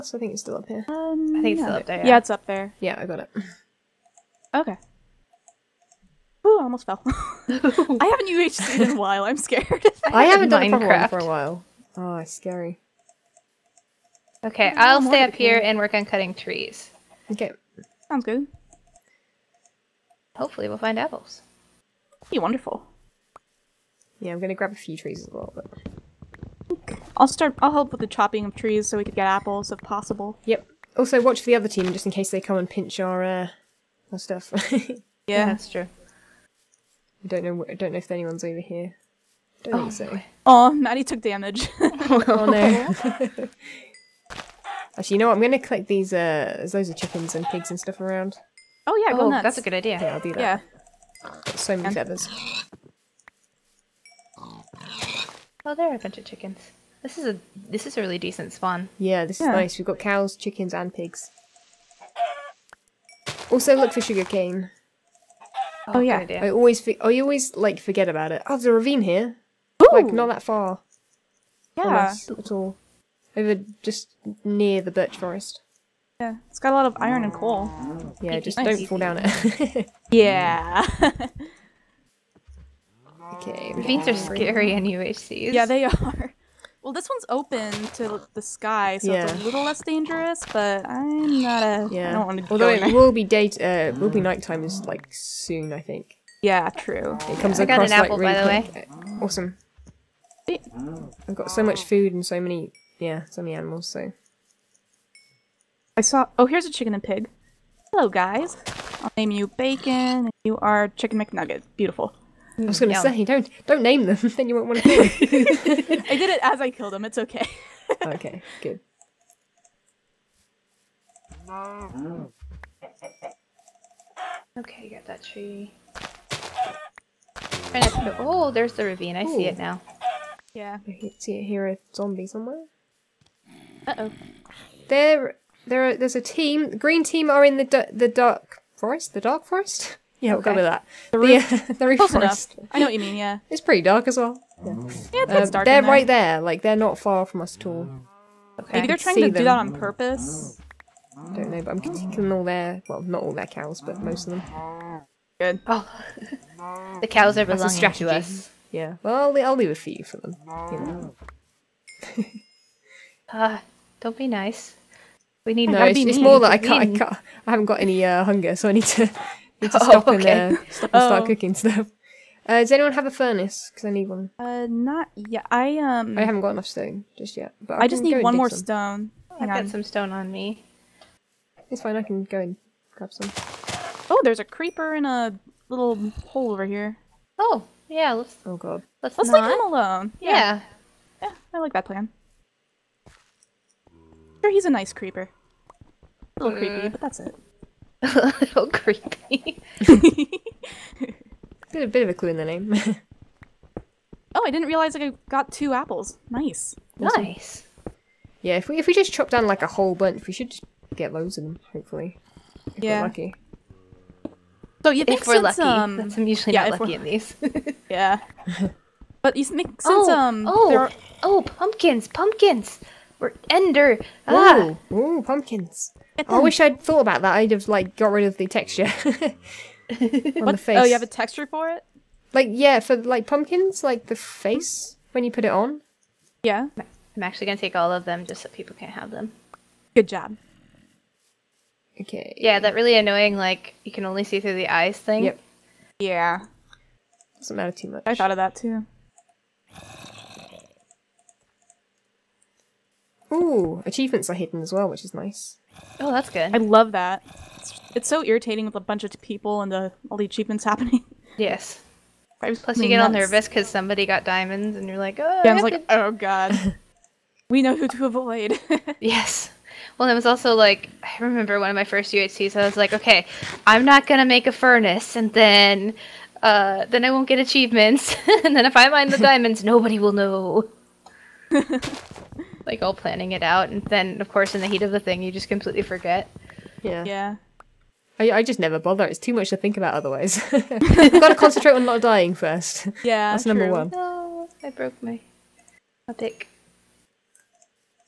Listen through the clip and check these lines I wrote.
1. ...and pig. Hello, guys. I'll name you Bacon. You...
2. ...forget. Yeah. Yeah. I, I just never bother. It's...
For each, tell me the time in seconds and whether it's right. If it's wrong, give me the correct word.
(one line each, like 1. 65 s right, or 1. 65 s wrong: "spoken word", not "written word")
1. 106 s right
2. 285 s right.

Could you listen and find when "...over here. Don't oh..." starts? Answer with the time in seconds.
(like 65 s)
38 s.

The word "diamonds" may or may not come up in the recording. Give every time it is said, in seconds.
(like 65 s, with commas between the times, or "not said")
264 s, 279 s.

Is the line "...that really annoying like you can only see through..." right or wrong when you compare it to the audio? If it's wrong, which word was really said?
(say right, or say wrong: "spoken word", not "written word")
right.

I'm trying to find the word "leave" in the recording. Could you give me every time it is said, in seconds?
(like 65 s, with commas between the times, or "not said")
159 s, 189 s.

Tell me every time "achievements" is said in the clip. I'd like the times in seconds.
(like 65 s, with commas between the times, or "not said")
253 s, 260 s, 277 s.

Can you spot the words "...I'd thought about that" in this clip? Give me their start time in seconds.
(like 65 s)
226 s.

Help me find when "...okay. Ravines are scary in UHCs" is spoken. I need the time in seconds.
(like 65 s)
83 s.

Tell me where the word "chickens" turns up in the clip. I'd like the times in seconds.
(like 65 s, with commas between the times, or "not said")
46 s, 56 s, 60 s, 106 s, 110 s.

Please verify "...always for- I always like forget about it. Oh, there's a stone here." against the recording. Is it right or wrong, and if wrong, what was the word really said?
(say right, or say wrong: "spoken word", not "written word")
wrong: "ravine", not "stone".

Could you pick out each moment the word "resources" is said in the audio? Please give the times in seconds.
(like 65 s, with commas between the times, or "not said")
not said.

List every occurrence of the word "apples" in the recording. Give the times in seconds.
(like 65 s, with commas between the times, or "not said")
20 s, 29 s, 97 s, 205 s.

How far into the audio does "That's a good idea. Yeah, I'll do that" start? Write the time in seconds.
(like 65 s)
49 s.